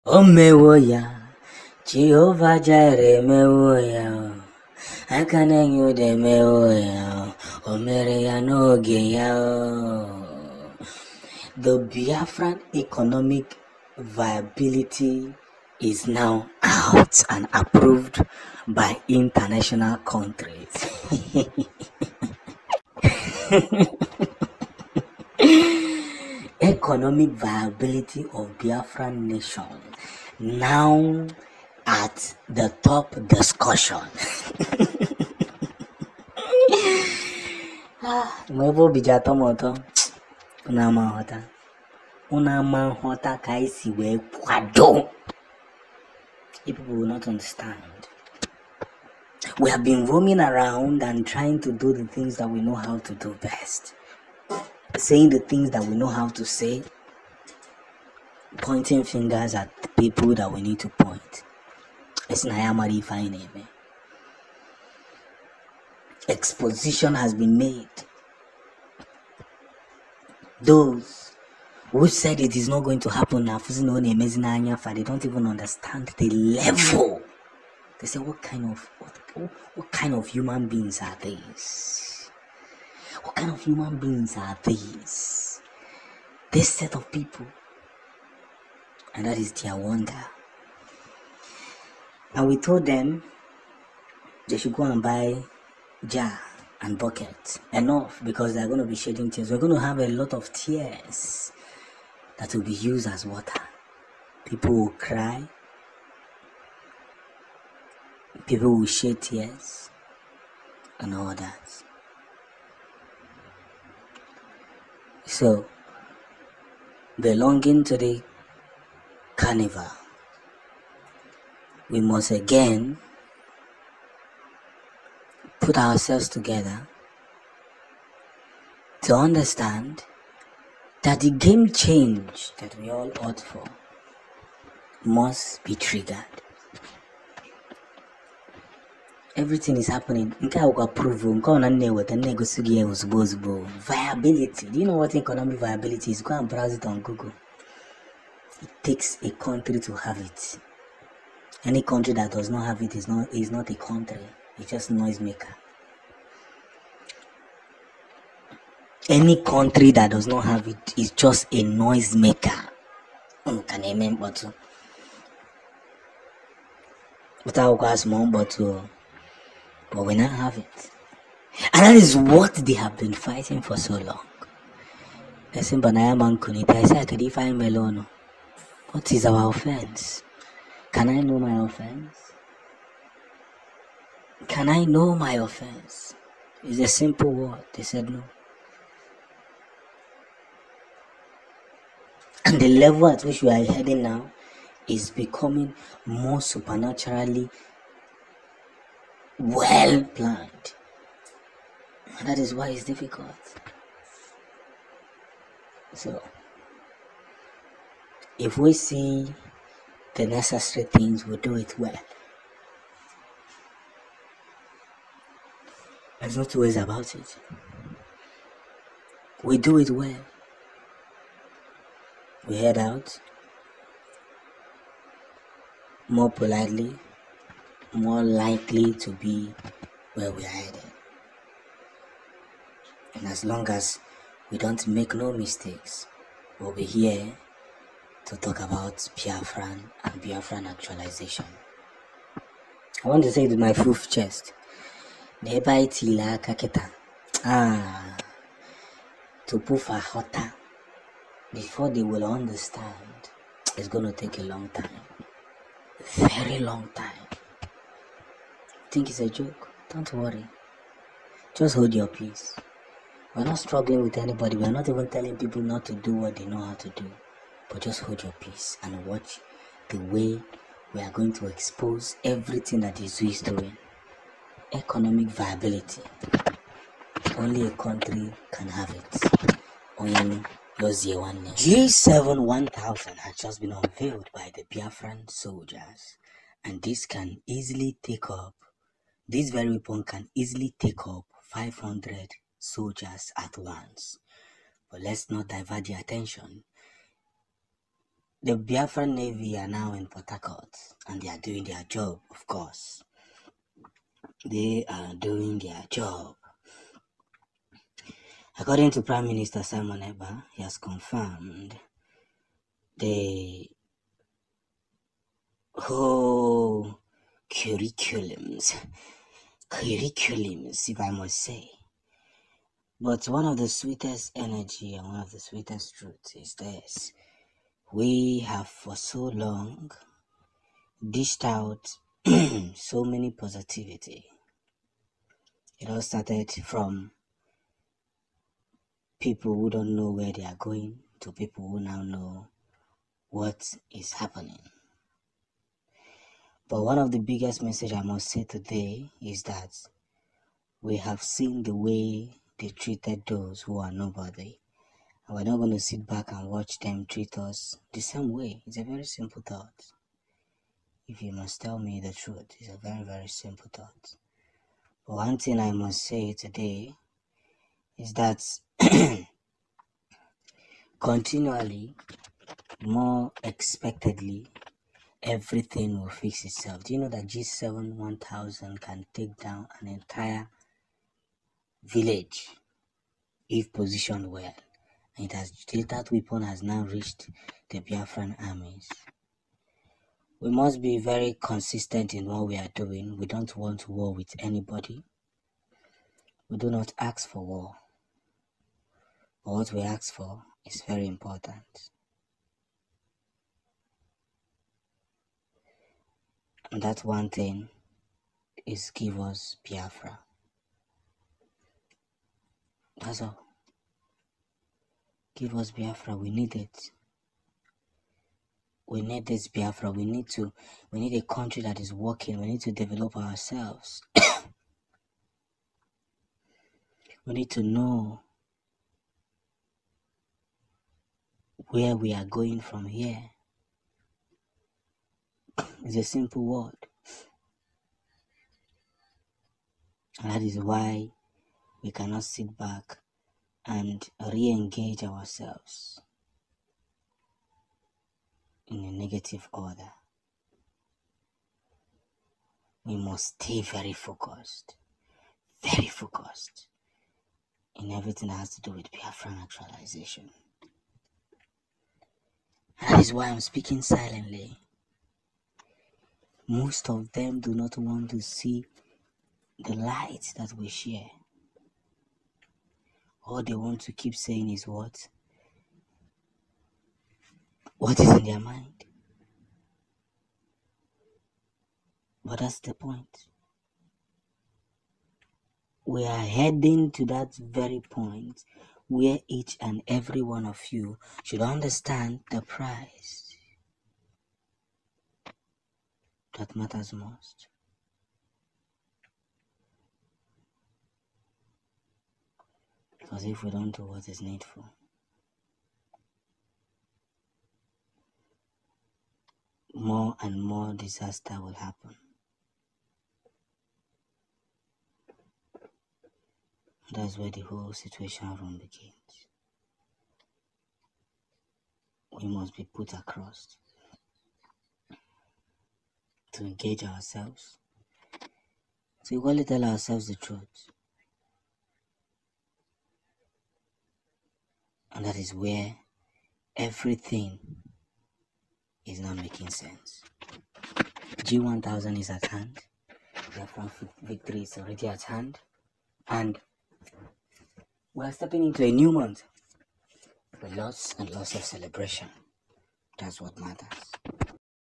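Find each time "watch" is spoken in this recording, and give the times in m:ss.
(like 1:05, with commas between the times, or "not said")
4:29, 5:56.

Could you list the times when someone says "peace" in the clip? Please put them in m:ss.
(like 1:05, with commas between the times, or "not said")
4:22, 4:28.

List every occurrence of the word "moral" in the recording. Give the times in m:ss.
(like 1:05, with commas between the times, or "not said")
not said.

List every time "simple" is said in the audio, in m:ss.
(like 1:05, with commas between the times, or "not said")
3:06, 5:59, 6:03, 7:16.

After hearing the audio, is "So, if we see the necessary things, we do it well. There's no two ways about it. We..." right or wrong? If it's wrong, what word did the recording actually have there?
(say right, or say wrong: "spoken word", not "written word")
right.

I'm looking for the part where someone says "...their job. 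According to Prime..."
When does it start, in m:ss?
5:05.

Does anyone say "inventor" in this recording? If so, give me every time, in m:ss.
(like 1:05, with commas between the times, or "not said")
not said.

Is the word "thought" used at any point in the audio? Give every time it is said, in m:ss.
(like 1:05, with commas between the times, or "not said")
5:59, 6:03.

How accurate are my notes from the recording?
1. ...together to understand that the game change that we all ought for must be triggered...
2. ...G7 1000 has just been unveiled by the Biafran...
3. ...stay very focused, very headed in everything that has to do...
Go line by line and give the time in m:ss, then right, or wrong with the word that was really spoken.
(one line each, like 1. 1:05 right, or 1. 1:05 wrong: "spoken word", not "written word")
1. 2:06 right
2. 4:40 right
3. 7:33 wrong: "focused", not "headed".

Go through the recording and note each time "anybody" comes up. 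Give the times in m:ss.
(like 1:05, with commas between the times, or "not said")
4:24, 6:34.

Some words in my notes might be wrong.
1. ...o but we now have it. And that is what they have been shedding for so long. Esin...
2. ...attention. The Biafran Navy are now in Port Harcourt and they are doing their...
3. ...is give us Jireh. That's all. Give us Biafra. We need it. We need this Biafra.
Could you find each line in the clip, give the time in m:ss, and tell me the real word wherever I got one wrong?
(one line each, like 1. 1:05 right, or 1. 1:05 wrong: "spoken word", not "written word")
1. 2:48 wrong: "fighting", not "shedding"
2. 4:55 right
3. 6:48 wrong: "Biafra", not "Jireh".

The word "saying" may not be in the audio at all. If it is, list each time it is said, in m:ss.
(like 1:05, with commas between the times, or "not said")
0:54, 7:54.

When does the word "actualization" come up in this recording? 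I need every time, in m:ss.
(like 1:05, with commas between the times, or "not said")
4:00, 7:39.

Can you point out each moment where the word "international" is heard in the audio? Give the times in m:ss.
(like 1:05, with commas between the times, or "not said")
0:19.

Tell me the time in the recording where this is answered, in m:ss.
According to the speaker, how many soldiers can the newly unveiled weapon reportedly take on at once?
4:51.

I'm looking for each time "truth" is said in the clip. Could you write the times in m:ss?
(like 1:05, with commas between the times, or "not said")
5:25, 6:02, 8:50.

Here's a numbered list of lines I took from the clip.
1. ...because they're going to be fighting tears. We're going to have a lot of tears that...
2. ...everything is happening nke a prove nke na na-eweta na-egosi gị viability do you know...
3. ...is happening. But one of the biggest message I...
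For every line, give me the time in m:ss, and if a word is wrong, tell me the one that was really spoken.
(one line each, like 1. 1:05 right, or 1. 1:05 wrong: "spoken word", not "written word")
1. 1:38 wrong: "shedding", not "fighting"
2. 2:19 right
3. 5:43 right.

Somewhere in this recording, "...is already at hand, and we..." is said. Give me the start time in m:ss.
9:04.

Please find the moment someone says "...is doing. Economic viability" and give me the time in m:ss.
4:33.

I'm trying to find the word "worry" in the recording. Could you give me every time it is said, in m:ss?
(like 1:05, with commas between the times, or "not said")
4:20.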